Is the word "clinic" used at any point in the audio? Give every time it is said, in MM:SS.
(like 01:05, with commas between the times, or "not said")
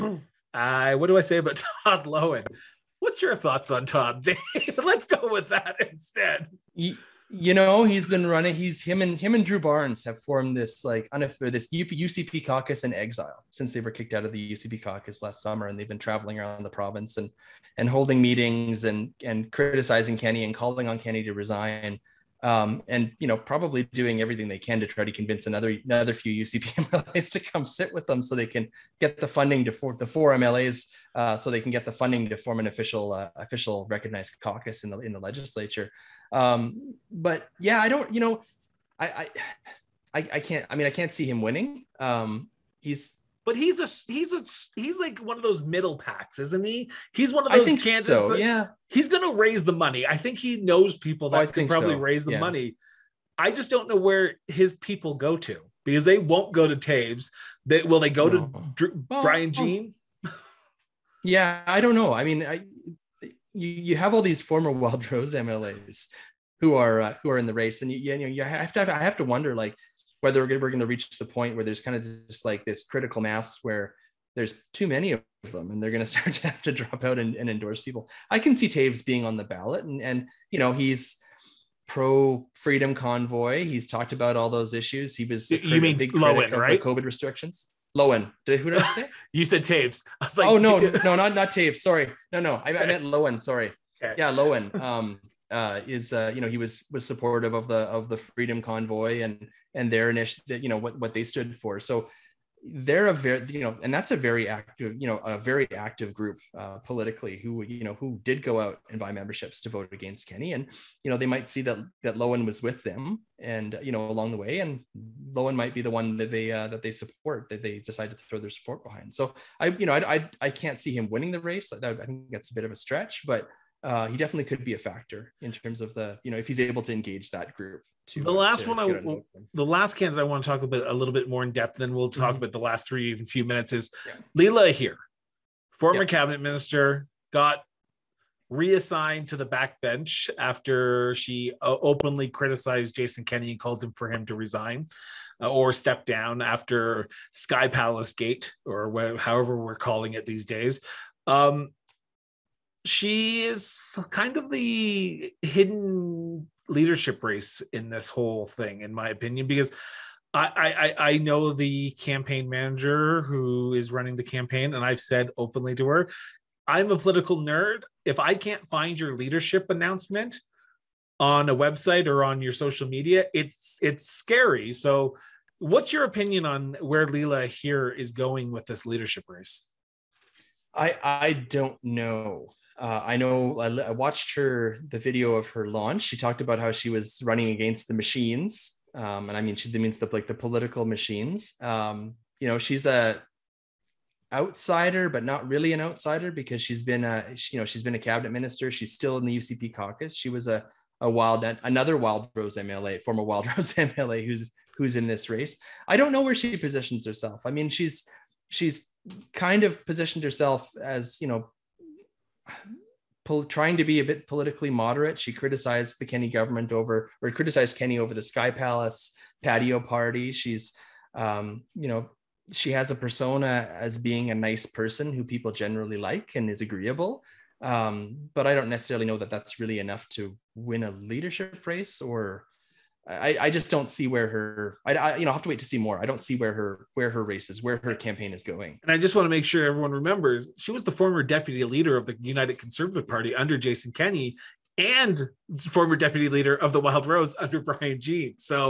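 not said.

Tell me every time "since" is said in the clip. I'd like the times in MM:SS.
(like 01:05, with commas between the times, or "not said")
00:13.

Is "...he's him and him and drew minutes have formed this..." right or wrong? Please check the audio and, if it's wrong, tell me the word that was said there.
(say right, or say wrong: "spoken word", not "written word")
wrong: "barnes", not "minutes".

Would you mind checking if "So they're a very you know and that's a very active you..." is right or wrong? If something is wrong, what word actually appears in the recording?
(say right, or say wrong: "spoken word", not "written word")
right.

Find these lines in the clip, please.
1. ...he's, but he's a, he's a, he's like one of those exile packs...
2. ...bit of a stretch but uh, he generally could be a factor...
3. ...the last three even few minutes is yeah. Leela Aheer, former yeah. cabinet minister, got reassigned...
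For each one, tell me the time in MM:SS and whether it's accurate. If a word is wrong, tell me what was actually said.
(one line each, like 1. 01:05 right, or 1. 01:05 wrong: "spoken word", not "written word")
1. 00:42 wrong: "middle", not "exile"
2. 02:02 wrong: "definitely", not "generally"
3. 02:12 right.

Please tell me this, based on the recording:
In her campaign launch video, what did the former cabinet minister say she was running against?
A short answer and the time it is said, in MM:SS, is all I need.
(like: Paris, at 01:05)
the machines, at 03:07.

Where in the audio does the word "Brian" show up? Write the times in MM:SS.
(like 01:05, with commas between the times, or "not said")
00:59, 04:07.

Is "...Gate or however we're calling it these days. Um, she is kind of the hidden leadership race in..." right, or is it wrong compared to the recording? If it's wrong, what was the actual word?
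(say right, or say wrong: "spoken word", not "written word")
right.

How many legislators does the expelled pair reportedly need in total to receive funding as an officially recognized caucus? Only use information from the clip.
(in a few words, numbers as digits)
4.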